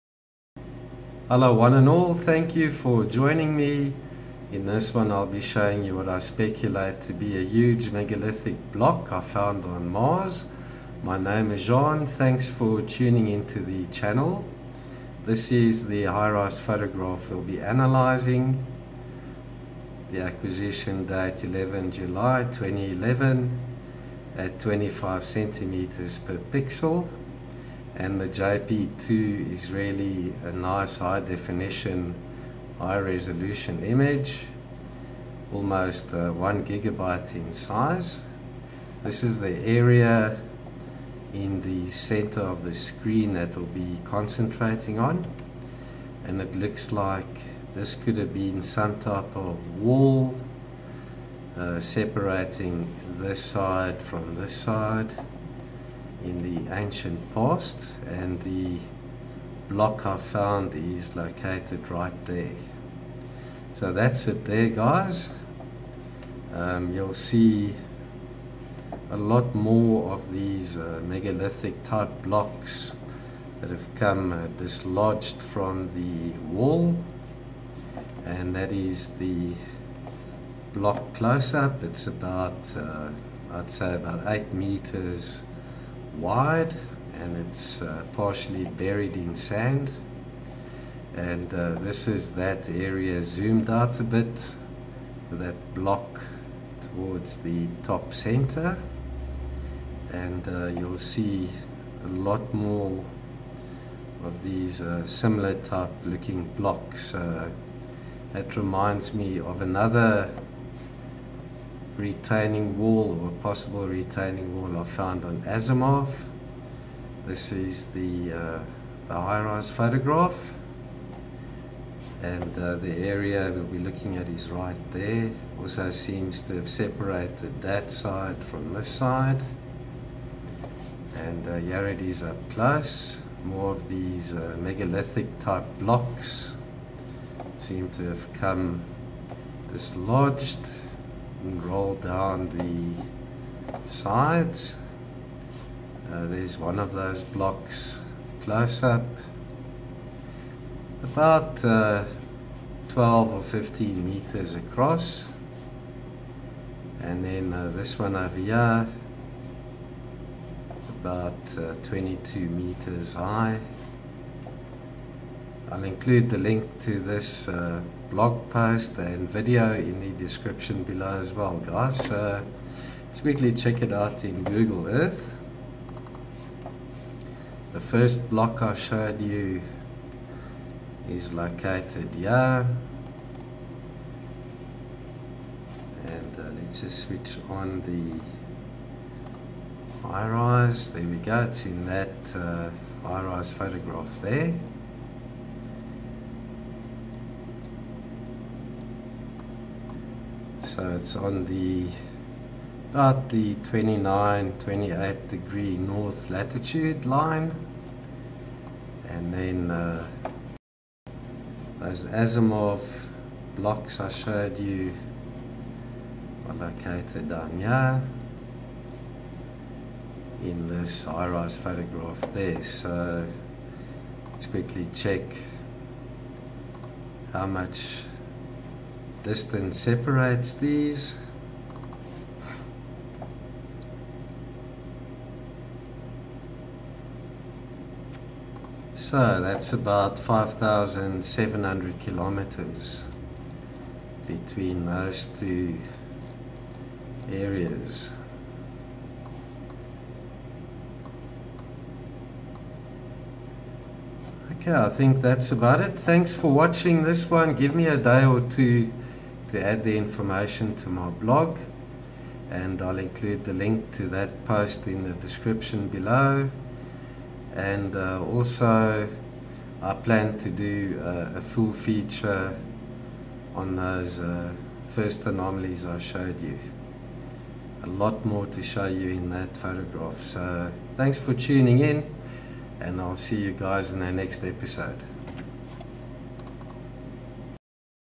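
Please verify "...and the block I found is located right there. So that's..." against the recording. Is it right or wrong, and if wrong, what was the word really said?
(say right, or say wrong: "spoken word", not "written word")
right.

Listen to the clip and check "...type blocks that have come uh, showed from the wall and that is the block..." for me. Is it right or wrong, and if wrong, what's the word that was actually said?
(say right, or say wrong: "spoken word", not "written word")
wrong: "dislodged", not "showed".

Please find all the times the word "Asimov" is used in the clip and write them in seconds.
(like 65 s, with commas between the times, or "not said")
115 s, 212 s.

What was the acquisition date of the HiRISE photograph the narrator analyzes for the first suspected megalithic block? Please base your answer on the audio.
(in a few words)
11 July 2011.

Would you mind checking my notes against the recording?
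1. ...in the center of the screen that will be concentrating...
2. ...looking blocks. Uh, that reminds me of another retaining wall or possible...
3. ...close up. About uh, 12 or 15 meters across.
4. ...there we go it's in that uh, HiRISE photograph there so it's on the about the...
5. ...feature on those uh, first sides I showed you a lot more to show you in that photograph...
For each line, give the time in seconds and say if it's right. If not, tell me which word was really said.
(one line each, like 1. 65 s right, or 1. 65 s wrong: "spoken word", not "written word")
1. 41 s right
2. 106 s right
3. 148 s right
4. 190 s right
5. 271 s wrong: "anomalies", not "sides".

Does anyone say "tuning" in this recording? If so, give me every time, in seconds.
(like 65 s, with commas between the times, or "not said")
12 s, 281 s.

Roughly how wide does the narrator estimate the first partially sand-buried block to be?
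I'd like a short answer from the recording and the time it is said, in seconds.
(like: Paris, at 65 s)
8 meters, at 84 s.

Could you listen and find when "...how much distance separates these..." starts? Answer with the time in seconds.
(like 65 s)
227 s.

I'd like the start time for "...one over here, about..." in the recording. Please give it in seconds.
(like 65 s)
157 s.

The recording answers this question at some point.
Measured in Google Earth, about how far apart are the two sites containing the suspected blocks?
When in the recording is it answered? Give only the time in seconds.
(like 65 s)
240 s.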